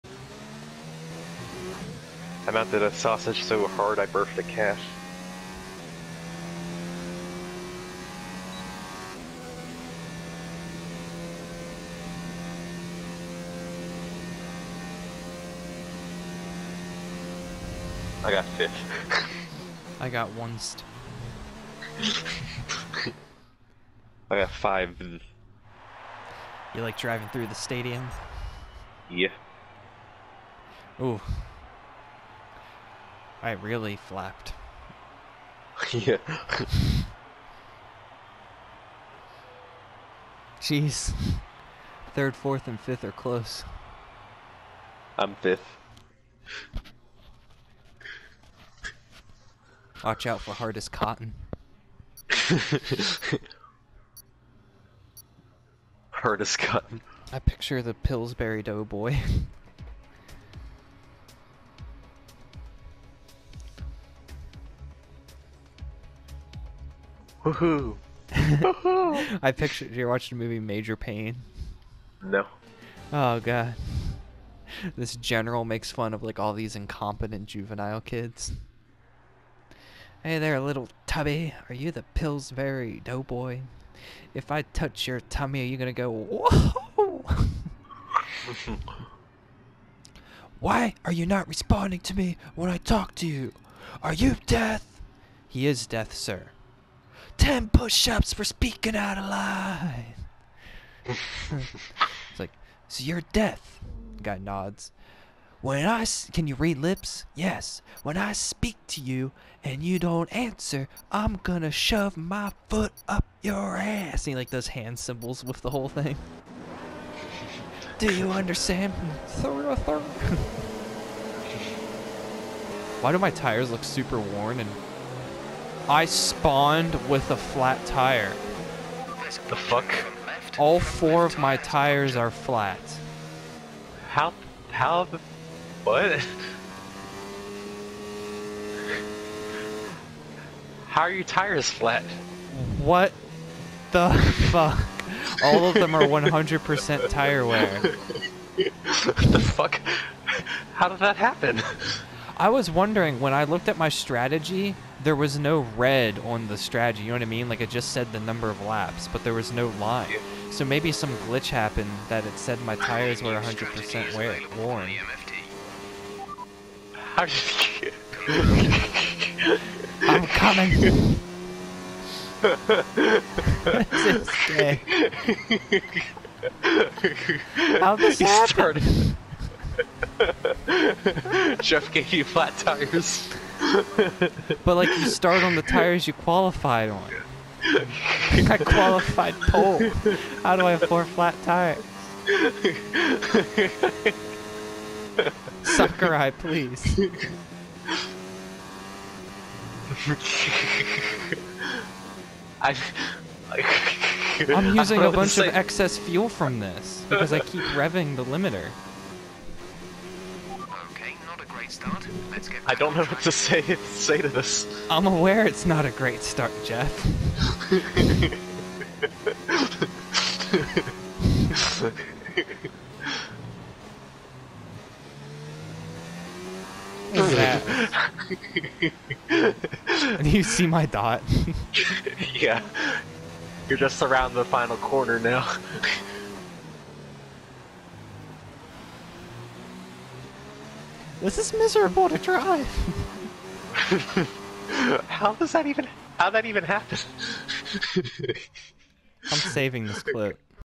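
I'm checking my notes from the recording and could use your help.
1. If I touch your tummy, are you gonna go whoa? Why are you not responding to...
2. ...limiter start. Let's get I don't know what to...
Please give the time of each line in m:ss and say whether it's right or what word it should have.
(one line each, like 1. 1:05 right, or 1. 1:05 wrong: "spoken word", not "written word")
1. 1:24 right
2. 3:28 right.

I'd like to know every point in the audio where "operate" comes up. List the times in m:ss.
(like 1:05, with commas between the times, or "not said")
not said.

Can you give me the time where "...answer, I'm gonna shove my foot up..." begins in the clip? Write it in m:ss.
1:50.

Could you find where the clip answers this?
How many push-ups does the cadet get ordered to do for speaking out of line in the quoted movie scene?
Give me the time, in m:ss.
1:37.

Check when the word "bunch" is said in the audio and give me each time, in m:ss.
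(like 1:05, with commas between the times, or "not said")
3:25.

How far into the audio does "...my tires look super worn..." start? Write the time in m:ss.
2:03.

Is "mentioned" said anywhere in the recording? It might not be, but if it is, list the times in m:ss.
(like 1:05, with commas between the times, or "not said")
not said.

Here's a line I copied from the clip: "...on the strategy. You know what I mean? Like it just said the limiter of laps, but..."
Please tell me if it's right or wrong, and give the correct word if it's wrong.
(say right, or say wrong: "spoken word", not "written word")
wrong: "number", not "limiter".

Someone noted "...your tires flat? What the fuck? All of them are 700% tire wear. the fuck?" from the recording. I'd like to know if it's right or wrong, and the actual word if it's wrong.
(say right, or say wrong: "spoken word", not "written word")
wrong: "100", not "700".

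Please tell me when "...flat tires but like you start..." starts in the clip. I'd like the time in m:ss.
3:02.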